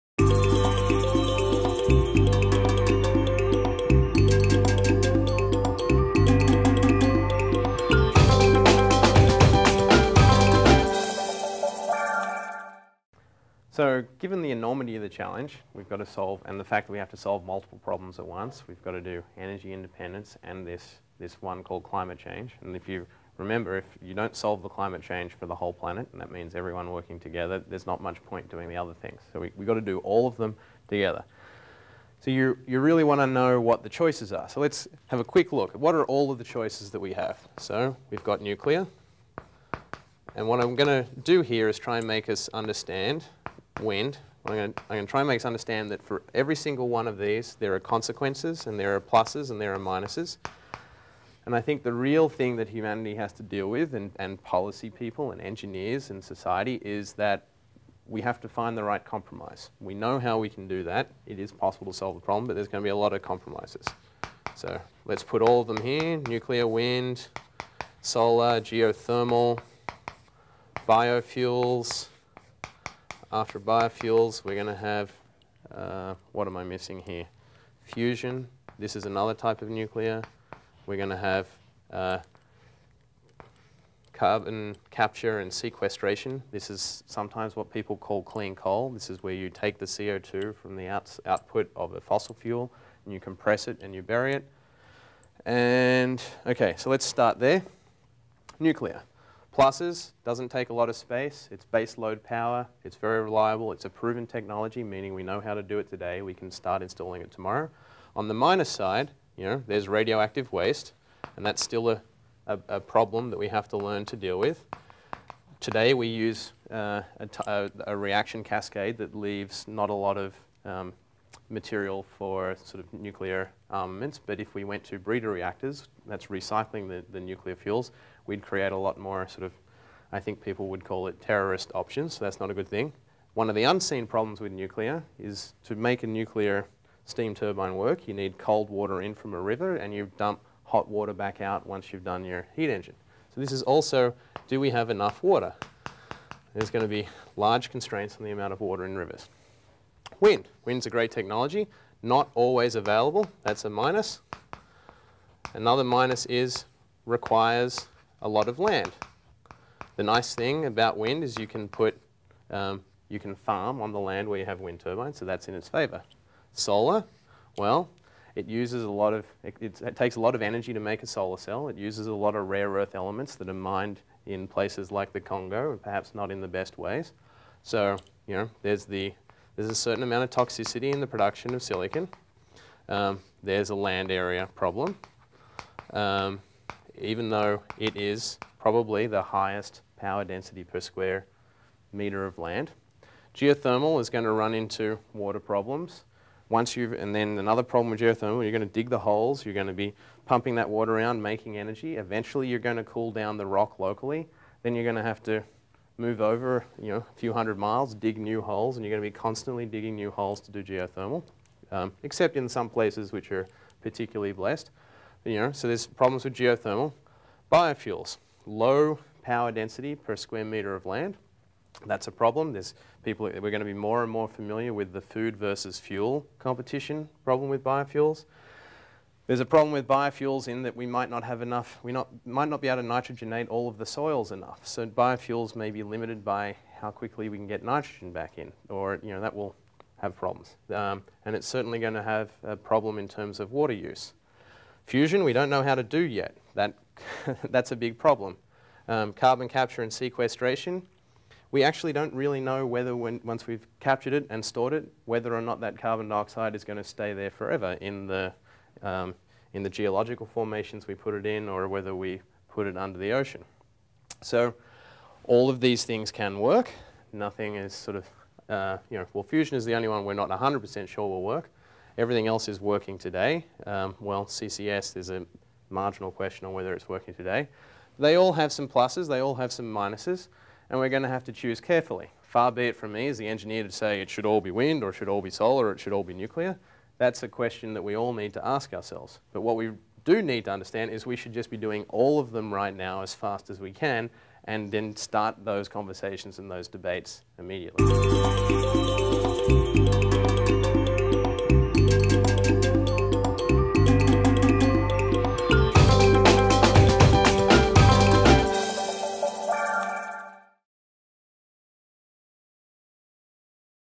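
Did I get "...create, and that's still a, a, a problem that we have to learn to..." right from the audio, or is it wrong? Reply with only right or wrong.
wrong.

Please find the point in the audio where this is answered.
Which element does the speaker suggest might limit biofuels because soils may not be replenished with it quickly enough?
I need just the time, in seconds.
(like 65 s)
237 s.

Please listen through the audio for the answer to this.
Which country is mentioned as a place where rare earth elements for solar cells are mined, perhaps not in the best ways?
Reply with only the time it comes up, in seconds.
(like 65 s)
175 s.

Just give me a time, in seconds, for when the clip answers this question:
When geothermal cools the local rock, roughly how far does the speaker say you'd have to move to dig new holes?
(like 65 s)
207 s.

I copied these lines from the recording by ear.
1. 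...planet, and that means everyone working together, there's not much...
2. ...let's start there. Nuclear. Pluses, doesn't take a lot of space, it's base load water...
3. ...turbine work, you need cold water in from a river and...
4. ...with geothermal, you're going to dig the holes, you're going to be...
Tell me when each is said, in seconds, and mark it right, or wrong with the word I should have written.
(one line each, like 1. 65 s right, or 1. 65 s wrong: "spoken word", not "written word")
1. 25 s right
2. 96 s wrong: "power", not "water"
3. 137 s right
4. 197 s right.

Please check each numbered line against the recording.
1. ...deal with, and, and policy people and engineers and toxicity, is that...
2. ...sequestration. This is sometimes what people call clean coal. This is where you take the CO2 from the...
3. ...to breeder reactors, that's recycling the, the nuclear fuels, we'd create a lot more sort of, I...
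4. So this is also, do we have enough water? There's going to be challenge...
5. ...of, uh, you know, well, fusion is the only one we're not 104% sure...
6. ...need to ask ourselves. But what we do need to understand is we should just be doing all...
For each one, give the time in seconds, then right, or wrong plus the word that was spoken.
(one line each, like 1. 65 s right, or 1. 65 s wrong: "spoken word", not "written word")
1. 53 s wrong: "society", not "toxicity"
2. 85 s right
3. 124 s right
4. 143 s wrong: "large", not "challenge"
5. 267 s wrong: "100", not "104"
6. 288 s right.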